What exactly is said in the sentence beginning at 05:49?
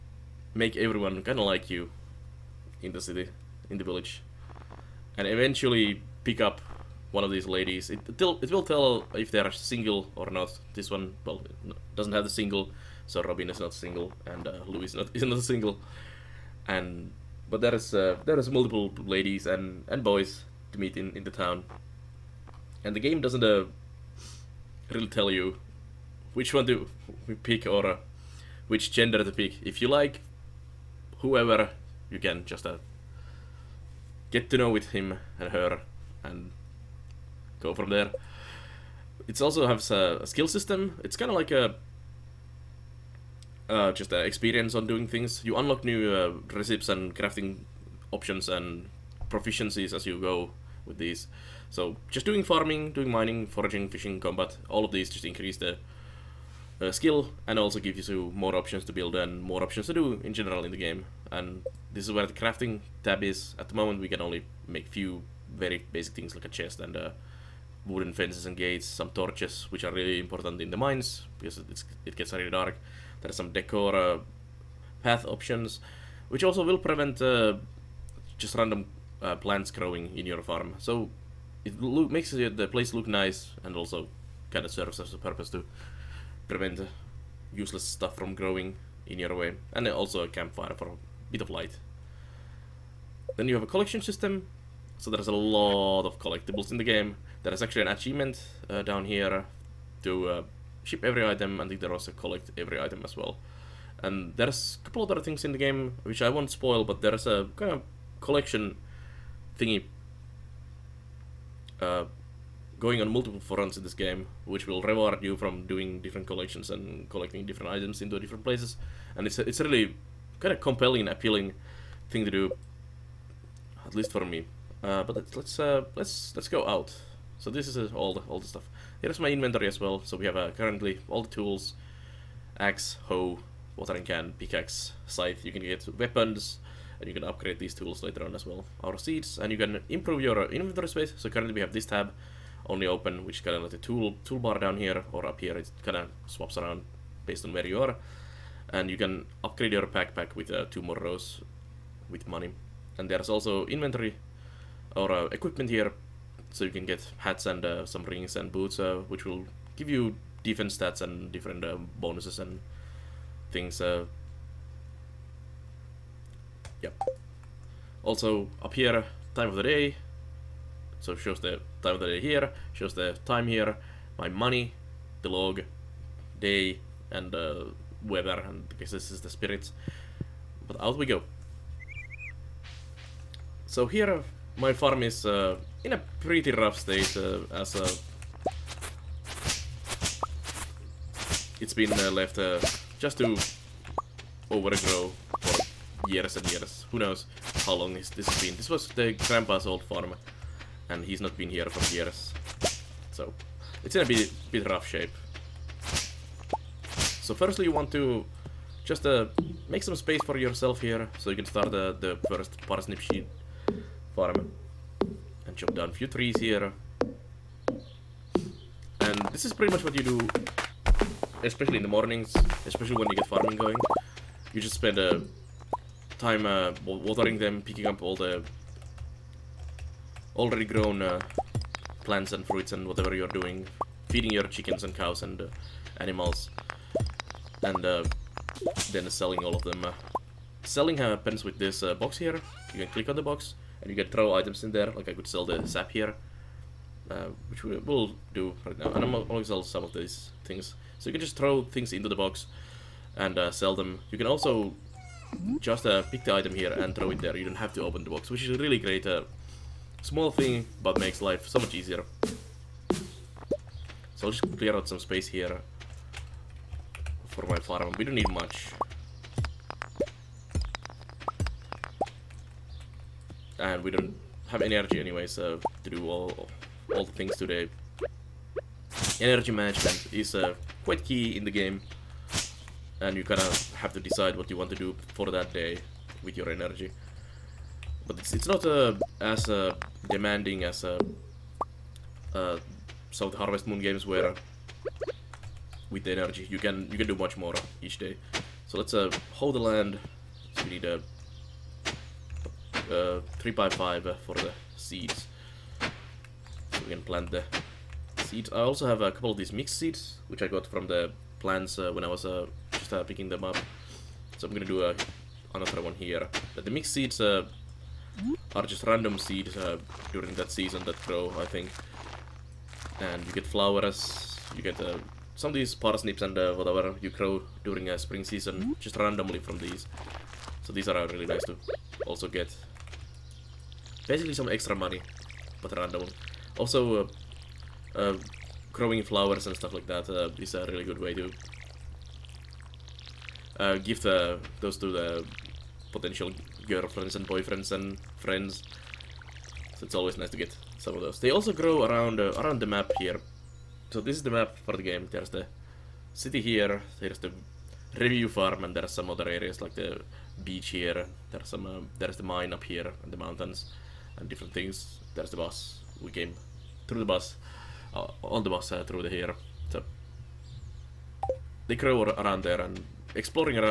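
So it's always nice to get some of those.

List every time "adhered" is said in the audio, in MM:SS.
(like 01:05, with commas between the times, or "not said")
not said.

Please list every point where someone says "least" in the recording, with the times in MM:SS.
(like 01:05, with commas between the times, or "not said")
02:03.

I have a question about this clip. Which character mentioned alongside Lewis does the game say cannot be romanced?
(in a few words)
Robin.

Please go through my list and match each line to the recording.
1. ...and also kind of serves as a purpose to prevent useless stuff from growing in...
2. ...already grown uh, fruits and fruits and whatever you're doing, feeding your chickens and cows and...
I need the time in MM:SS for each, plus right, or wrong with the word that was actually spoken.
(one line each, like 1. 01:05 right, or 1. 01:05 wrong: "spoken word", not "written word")
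1. 01:23 right
2. 03:50 wrong: "plants", not "fruits".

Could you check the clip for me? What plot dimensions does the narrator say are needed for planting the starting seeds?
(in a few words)
3 by 5.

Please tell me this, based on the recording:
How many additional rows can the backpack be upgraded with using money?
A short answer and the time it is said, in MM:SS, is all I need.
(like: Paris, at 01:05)
2, at 02:30.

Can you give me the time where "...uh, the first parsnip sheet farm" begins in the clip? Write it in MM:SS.
03:31.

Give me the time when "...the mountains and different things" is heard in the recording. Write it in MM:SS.
06:03.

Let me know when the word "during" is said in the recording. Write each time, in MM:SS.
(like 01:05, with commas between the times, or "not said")
05:20, 05:27.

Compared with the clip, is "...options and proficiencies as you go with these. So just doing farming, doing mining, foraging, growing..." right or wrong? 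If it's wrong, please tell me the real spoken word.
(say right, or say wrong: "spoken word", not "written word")
wrong: "fishing", not "growing".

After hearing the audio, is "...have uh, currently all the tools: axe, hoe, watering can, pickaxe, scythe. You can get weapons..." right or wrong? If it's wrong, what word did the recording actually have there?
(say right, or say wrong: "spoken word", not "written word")
right.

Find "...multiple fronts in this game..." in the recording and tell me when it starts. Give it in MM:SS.
01:53.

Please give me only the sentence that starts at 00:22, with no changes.
And the game doesn't uh, really tell you which one to pick or uh, which gender to pick.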